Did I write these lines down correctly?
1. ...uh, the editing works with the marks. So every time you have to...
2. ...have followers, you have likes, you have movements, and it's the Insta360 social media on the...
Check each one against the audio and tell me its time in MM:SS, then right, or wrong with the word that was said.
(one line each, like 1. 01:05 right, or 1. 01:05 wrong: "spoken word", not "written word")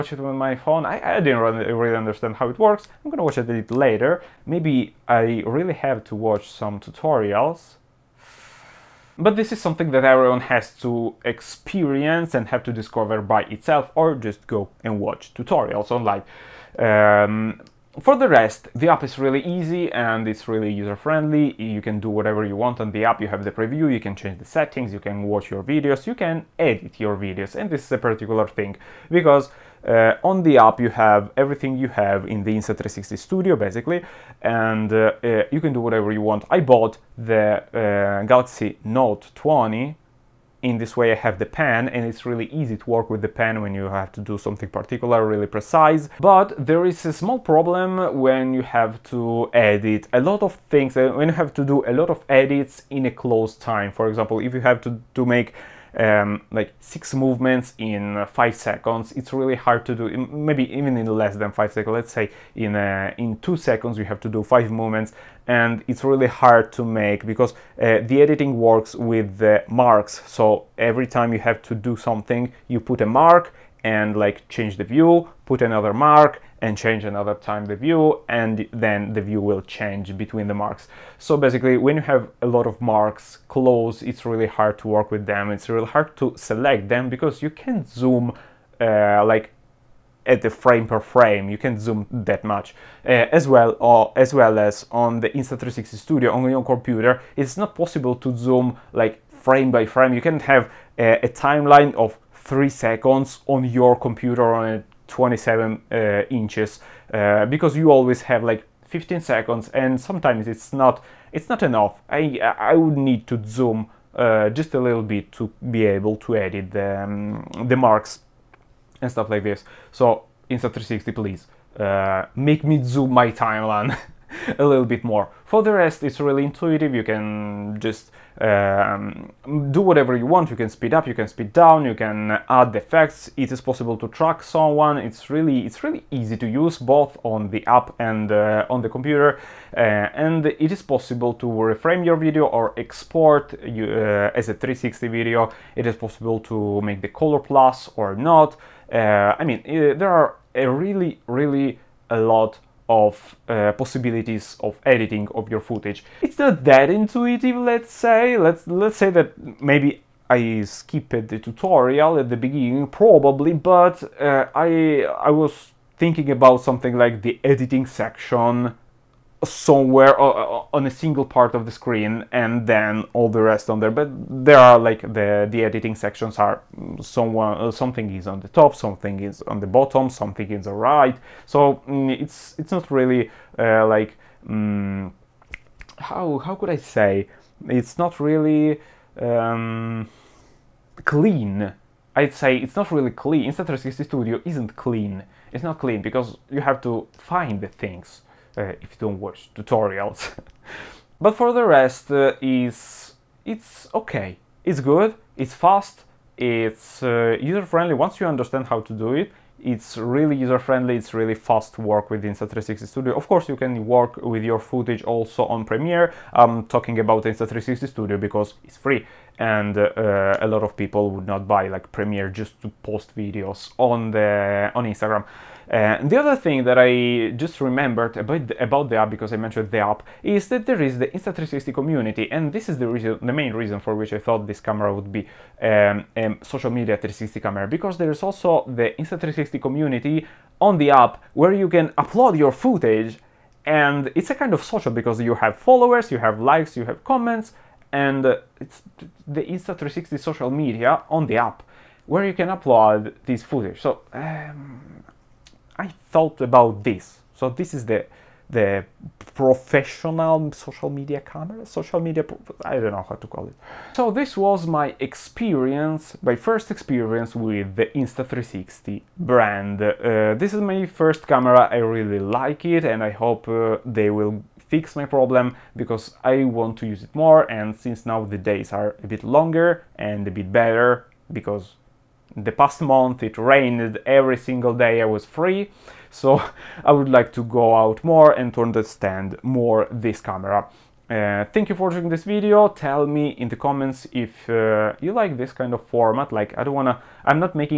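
1. 01:07 right
2. 04:05 wrong: "comments", not "movements".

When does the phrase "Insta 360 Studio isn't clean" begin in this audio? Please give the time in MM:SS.
03:13.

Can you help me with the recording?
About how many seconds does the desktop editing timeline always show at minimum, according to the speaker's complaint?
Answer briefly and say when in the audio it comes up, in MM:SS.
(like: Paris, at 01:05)
15 seconds, at 01:48.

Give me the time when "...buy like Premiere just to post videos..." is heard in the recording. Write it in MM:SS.
03:41.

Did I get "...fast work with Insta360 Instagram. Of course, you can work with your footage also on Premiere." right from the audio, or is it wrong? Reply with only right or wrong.
wrong.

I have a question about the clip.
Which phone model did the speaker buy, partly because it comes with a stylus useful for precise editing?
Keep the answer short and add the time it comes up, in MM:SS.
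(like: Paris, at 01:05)
Galaxy Note 20, at 00:38.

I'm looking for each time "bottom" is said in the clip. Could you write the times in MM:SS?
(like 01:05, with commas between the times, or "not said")
02:59.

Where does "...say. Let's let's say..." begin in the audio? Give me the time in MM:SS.
02:37.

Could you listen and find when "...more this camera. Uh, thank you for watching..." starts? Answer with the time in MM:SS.
04:49.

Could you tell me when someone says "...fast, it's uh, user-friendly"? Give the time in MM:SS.
03:25.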